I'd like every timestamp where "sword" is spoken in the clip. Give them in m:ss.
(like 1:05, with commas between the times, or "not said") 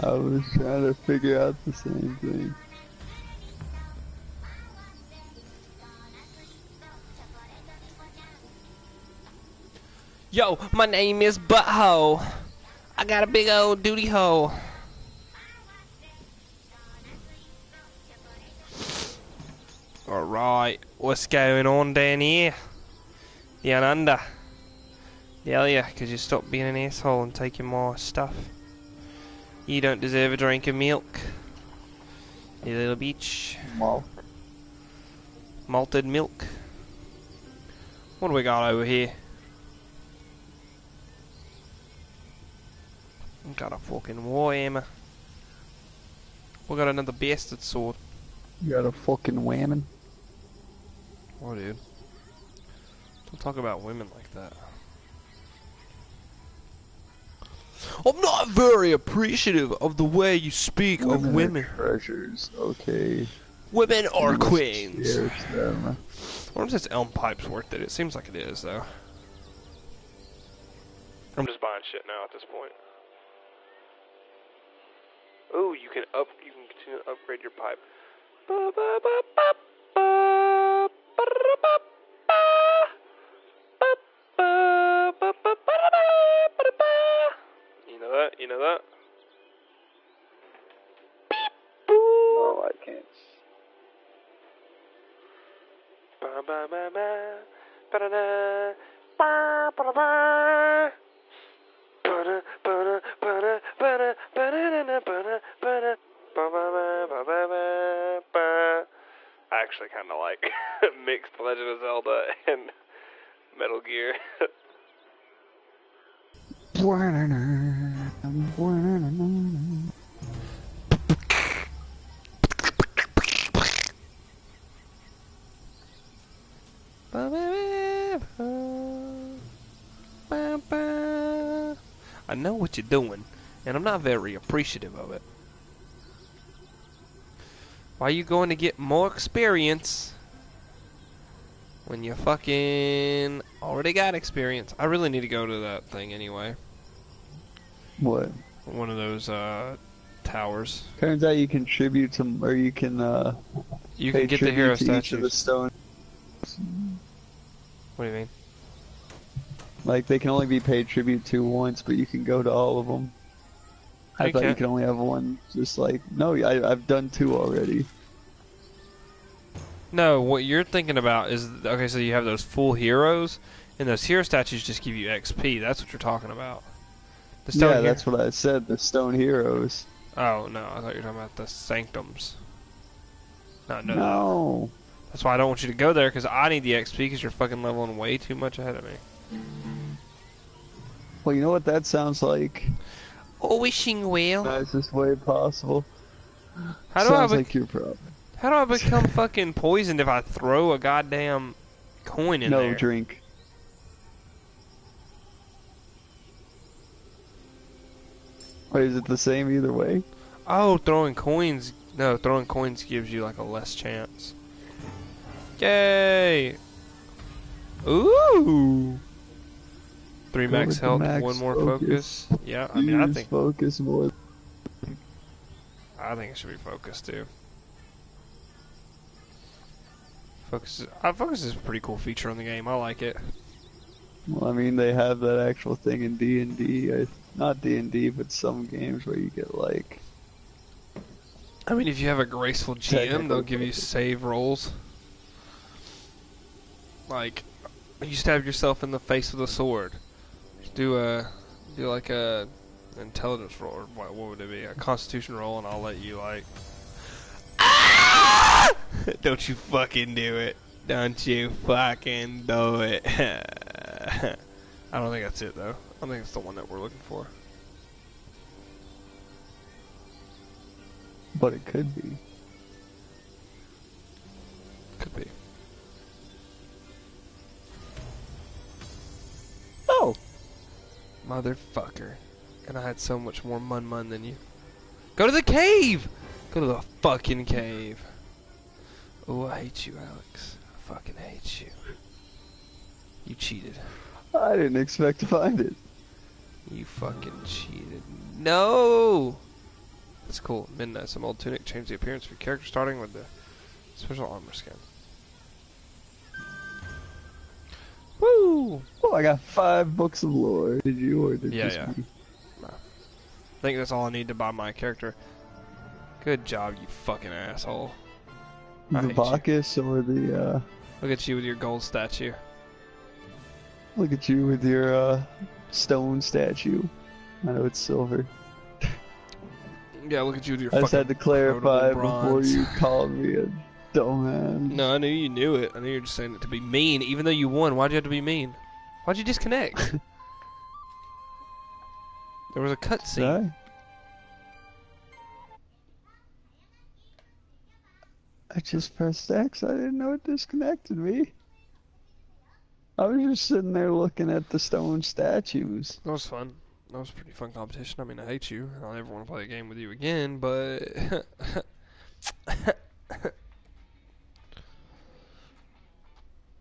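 0:47, 4:09.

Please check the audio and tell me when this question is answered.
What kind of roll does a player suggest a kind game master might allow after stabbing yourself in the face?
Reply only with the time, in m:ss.
4:14.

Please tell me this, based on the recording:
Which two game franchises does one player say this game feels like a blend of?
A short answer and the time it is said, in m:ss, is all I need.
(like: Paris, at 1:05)
Legend of Zelda and Metal Gear, at 1:51.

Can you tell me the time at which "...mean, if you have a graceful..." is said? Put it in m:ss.
4:01.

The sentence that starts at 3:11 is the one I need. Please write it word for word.
Well, you know what that sounds like?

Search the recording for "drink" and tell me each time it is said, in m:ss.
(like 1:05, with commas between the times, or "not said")
0:30, 3:22.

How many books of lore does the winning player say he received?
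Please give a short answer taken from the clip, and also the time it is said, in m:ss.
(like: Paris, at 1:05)
5, at 5:09.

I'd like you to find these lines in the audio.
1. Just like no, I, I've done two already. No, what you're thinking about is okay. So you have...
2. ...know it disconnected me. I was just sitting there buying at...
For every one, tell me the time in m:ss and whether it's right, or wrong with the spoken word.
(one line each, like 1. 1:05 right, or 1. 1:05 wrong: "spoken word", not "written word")
1. 2:45 right
2. 5:49 wrong: "looking", not "buying".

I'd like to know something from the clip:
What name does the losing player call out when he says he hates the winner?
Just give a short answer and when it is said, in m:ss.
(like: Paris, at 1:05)
Alex, at 4:49.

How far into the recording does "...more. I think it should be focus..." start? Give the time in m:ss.
3:43.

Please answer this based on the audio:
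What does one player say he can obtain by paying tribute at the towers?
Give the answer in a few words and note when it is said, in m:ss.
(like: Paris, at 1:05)
Hero statue stone, at 2:34.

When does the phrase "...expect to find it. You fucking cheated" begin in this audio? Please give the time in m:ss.
4:54.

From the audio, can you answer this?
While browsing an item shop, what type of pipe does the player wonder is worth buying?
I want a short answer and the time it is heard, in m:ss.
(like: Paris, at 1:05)
Elm pipe, at 1:06.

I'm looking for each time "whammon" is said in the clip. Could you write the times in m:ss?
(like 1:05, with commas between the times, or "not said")
0:49.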